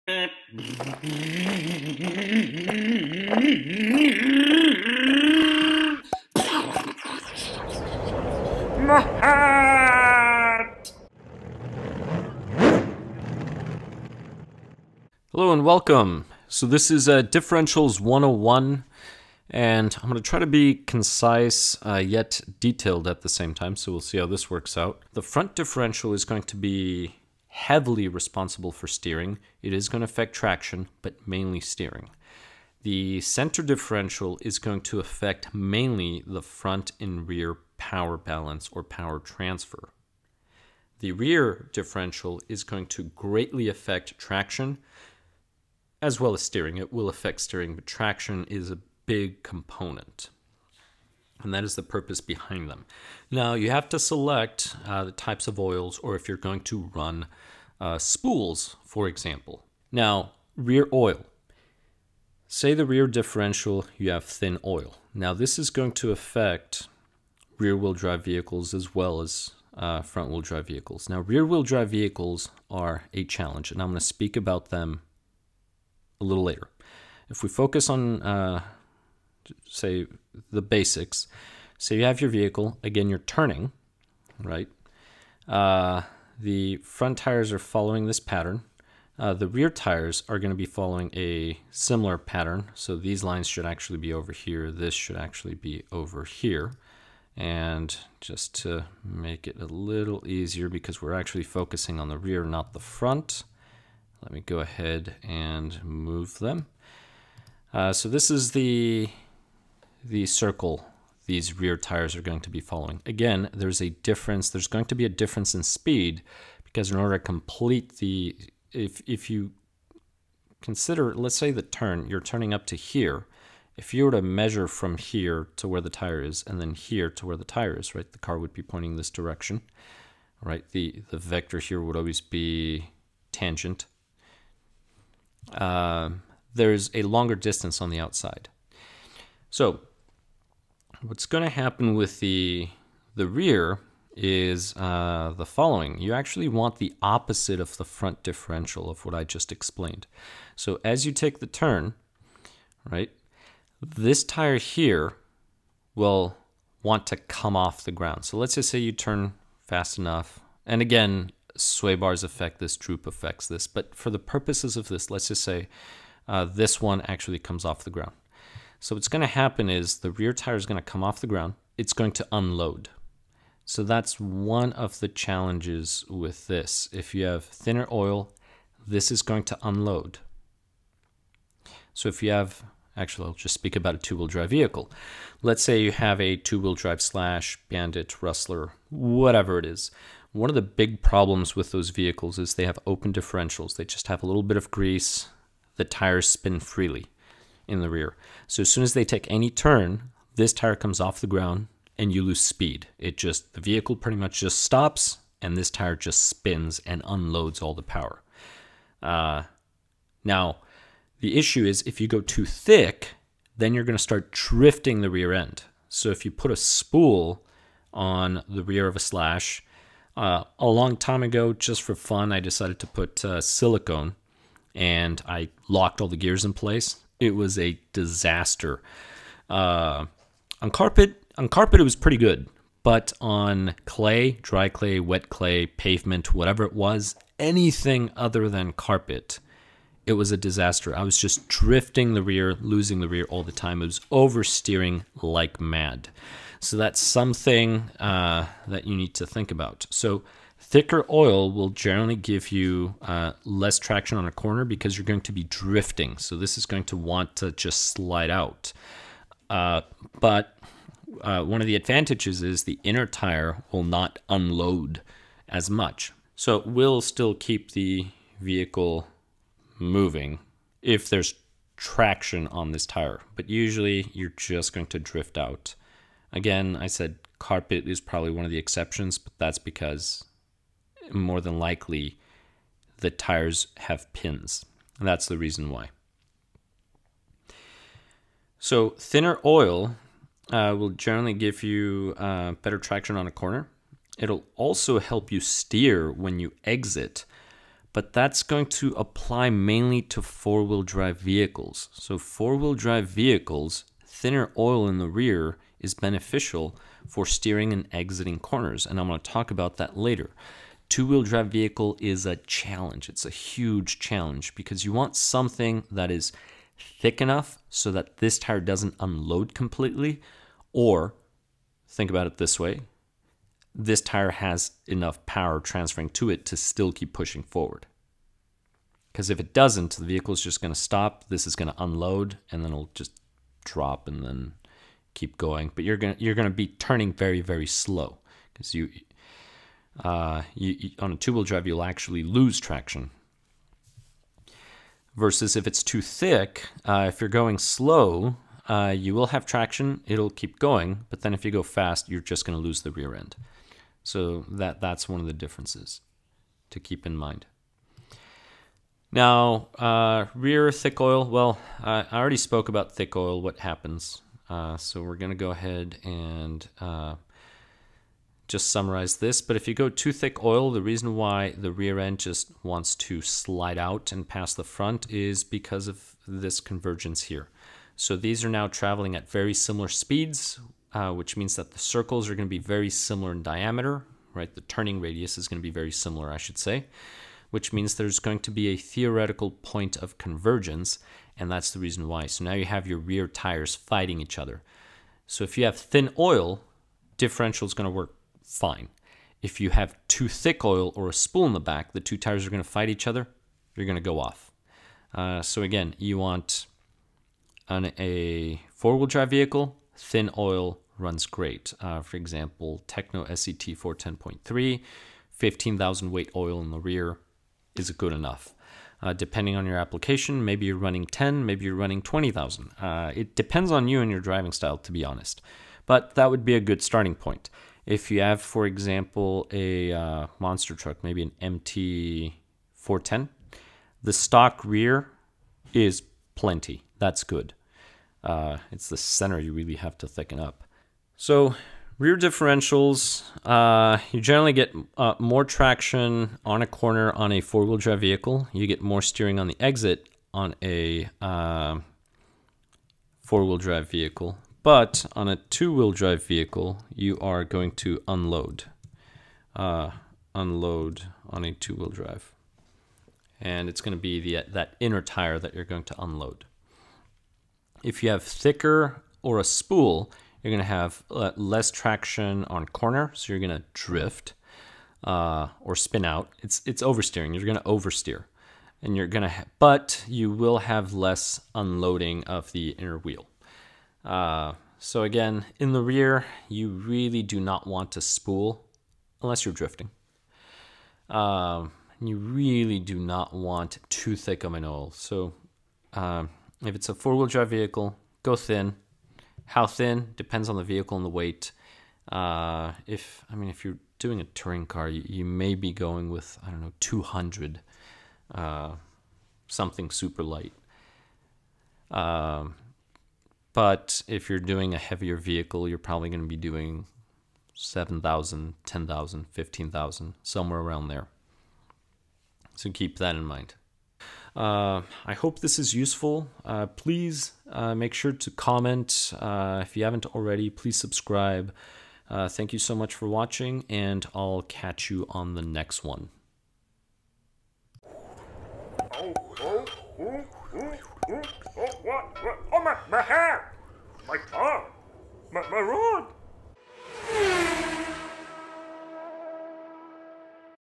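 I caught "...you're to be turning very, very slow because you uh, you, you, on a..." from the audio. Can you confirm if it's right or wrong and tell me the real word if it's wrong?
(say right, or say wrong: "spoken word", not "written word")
right.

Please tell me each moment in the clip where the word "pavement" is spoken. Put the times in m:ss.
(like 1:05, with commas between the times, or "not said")
3:55.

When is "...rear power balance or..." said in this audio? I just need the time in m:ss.
0:37.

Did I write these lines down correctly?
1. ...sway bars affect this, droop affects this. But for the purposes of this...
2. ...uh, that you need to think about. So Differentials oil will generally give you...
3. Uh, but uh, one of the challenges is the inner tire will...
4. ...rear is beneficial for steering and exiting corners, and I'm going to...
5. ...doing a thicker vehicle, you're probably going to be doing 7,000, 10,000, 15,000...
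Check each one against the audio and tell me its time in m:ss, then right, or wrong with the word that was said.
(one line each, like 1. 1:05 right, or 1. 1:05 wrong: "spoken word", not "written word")
1. 2:41 right
2. 4:07 wrong: "Thicker", not "Differentials"
3. 4:19 wrong: "advantages", not "challenges"
4. 5:05 right
5. 8:34 wrong: "heavier", not "thicker".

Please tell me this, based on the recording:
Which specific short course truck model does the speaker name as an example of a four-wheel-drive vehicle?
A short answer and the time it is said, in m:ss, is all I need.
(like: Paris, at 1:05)
Tekno SCT 410.3, at 6:52.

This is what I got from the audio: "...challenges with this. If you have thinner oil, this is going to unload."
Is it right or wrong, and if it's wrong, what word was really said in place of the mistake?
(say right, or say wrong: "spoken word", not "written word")
right.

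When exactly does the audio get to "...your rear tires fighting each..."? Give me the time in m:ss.
6:32.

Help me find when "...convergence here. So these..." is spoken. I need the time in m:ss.
6:16.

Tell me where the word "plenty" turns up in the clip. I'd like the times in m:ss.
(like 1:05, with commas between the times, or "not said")
7:16.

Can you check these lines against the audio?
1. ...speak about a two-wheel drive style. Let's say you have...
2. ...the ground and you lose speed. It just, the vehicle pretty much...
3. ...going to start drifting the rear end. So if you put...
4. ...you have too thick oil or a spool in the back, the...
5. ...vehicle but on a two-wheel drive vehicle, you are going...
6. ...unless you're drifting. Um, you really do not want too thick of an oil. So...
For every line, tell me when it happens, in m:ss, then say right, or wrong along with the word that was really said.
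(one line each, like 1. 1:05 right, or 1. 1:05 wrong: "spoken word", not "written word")
1. 3:03 wrong: "vehicle", not "style"
2. 3:21 right
3. 3:33 right
4. 6:39 right
5. 7:33 right
6. 8:09 right.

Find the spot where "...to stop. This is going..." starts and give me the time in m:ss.
5:30.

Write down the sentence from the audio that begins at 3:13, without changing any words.
They just have a little bit of grease.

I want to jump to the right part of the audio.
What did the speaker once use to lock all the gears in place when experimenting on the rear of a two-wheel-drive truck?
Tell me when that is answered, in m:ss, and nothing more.
3:43.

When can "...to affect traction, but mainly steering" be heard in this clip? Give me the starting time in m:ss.
0:29.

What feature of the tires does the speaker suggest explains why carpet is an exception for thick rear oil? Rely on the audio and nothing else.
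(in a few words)
Pins.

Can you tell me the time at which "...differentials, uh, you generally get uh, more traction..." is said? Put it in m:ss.
7:22.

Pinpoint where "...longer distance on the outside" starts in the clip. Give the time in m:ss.
2:17.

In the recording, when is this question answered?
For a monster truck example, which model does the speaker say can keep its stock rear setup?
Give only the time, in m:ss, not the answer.
7:11.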